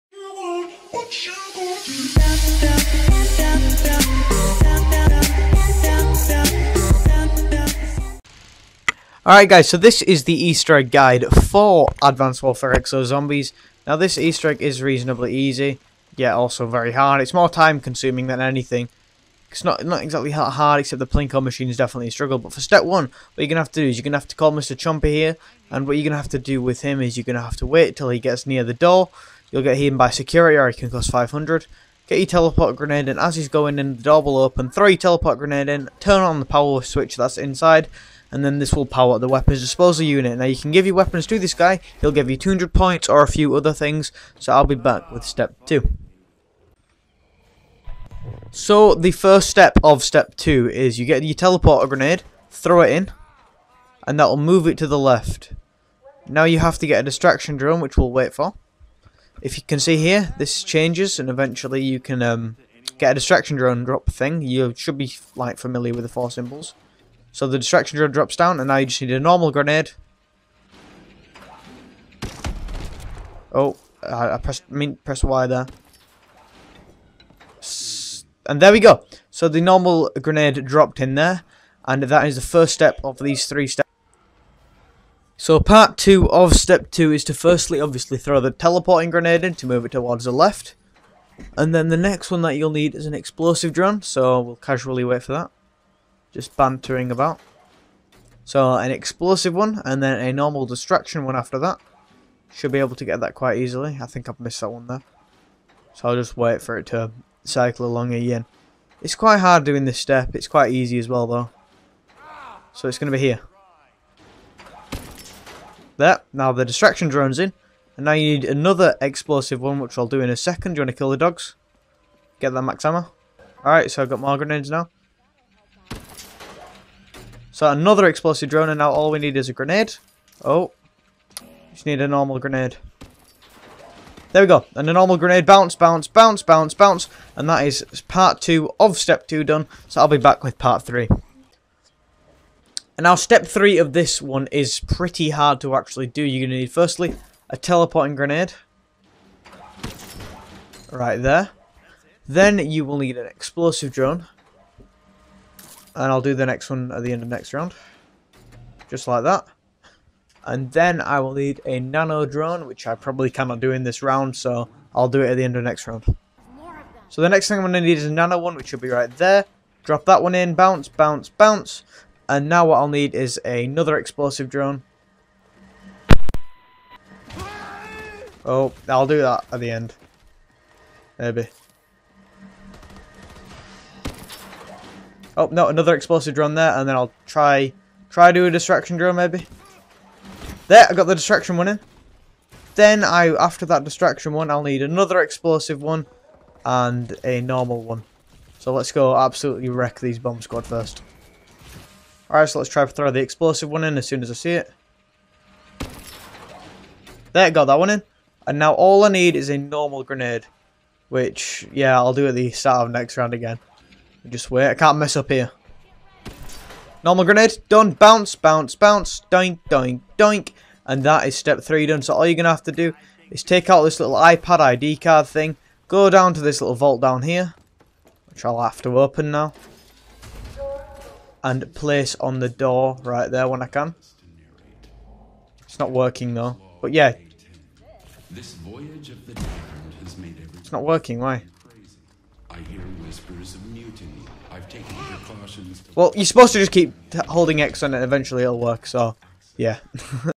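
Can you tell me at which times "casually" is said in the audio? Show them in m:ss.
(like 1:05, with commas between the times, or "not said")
1:34.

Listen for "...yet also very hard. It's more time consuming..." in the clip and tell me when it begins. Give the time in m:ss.
0:16.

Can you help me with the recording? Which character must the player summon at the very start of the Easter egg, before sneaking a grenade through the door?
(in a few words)
Mr. Chompy.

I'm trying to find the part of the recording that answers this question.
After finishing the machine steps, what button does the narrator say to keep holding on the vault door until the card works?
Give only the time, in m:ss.
4:07.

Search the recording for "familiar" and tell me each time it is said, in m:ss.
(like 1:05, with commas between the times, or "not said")
1:05.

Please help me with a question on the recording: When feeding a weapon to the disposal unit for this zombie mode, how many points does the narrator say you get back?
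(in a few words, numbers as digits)
200.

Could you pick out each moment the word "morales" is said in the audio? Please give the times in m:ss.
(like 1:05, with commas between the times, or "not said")
not said.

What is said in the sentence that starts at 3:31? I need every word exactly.
Which, yeah, I'll do at the start of next round again.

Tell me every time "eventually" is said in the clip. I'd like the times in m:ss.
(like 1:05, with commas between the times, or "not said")
1:01, 4:08.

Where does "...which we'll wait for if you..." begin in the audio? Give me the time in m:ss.
0:57.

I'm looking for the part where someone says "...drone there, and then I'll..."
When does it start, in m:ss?
3:06.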